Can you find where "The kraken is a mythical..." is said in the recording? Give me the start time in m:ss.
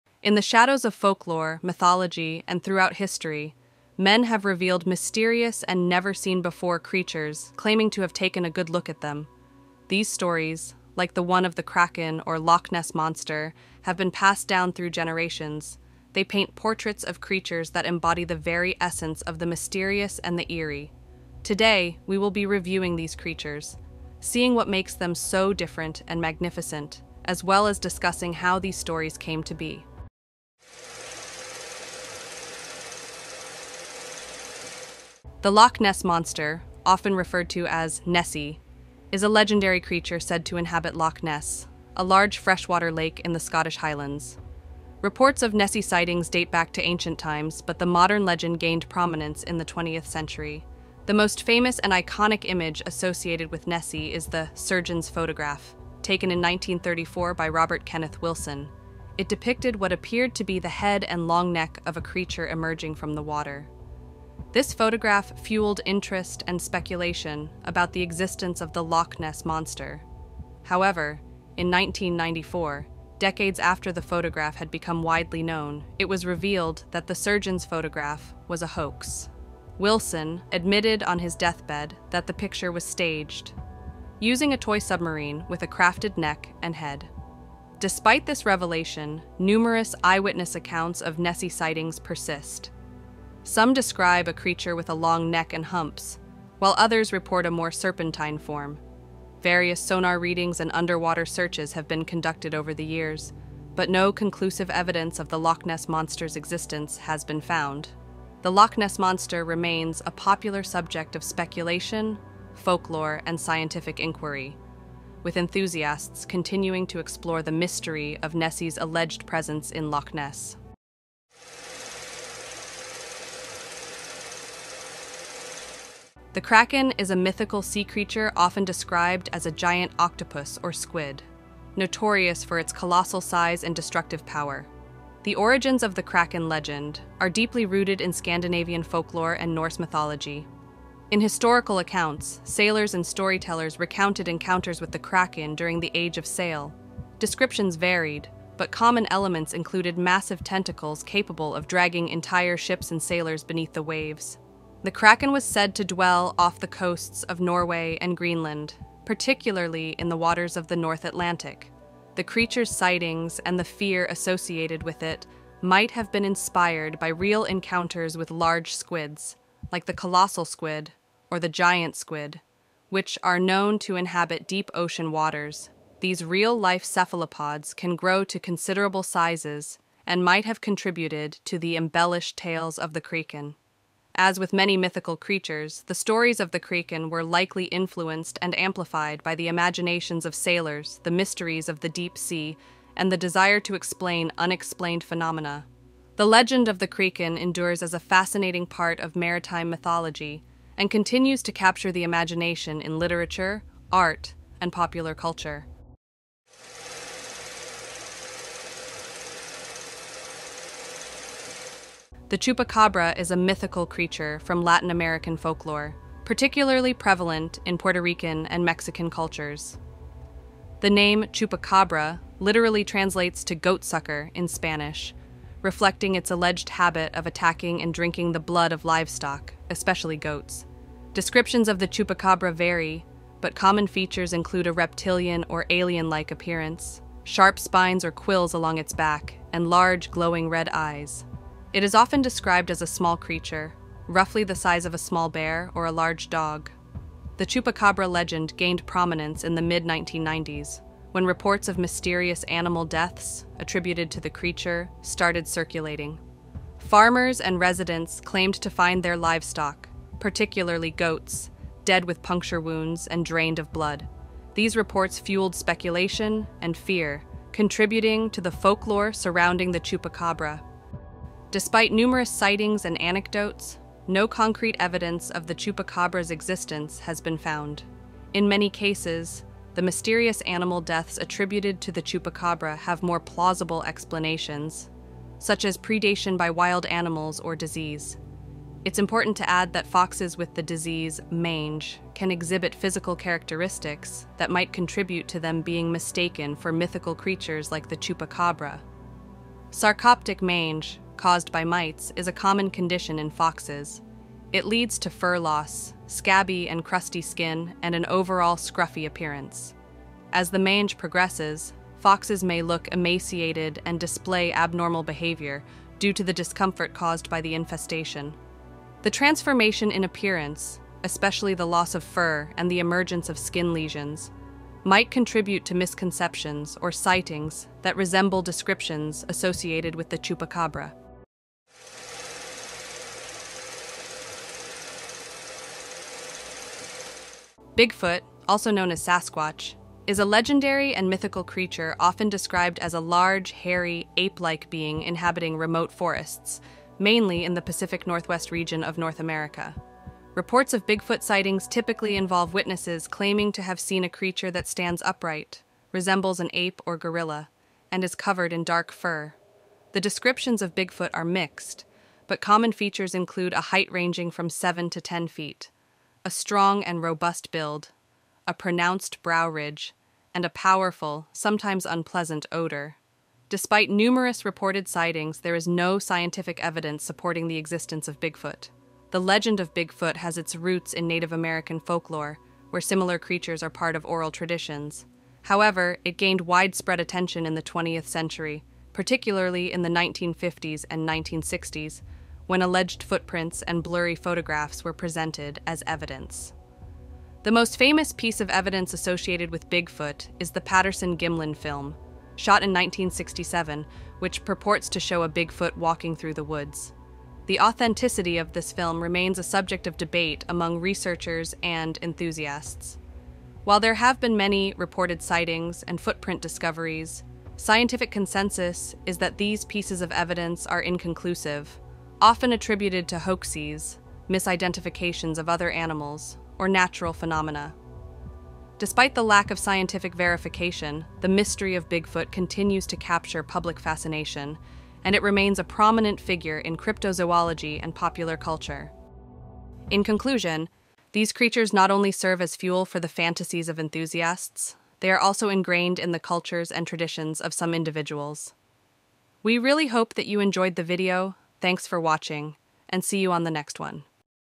2:06.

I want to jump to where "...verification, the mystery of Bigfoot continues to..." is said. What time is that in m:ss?
7:10.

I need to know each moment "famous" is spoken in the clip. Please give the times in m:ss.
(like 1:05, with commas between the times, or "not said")
0:51, 6:37.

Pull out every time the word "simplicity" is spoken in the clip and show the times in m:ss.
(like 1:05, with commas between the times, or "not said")
not said.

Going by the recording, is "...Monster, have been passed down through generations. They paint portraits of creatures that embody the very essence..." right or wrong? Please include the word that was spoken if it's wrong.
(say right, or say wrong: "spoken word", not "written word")
right.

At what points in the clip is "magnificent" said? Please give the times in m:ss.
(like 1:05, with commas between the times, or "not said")
0:26.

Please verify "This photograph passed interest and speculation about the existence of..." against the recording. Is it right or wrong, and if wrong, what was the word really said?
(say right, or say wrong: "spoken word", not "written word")
wrong: "fueled", not "passed".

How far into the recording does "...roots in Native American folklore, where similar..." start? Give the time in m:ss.
6:20.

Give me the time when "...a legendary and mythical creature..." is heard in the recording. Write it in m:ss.
5:40.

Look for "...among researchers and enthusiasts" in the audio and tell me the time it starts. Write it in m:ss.
6:50.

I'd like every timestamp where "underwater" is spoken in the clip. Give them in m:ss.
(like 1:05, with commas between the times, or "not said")
1:40.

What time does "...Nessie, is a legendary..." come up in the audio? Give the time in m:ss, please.
0:38.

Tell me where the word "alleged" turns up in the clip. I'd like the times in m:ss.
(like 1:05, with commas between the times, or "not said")
1:58, 3:46, 6:32.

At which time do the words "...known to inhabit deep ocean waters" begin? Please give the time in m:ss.
2:53.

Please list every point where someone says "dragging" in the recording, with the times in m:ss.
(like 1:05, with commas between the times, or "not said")
2:31.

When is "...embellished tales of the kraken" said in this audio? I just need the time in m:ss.
3:01.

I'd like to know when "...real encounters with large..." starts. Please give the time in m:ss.
2:47.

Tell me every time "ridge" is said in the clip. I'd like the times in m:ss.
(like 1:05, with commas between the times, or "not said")
6:09.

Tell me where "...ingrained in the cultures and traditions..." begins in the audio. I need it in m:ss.
7:25.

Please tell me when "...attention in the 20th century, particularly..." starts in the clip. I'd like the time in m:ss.
6:26.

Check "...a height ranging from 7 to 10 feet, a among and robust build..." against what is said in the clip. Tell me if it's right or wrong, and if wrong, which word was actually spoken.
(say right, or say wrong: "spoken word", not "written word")
wrong: "strong", not "among".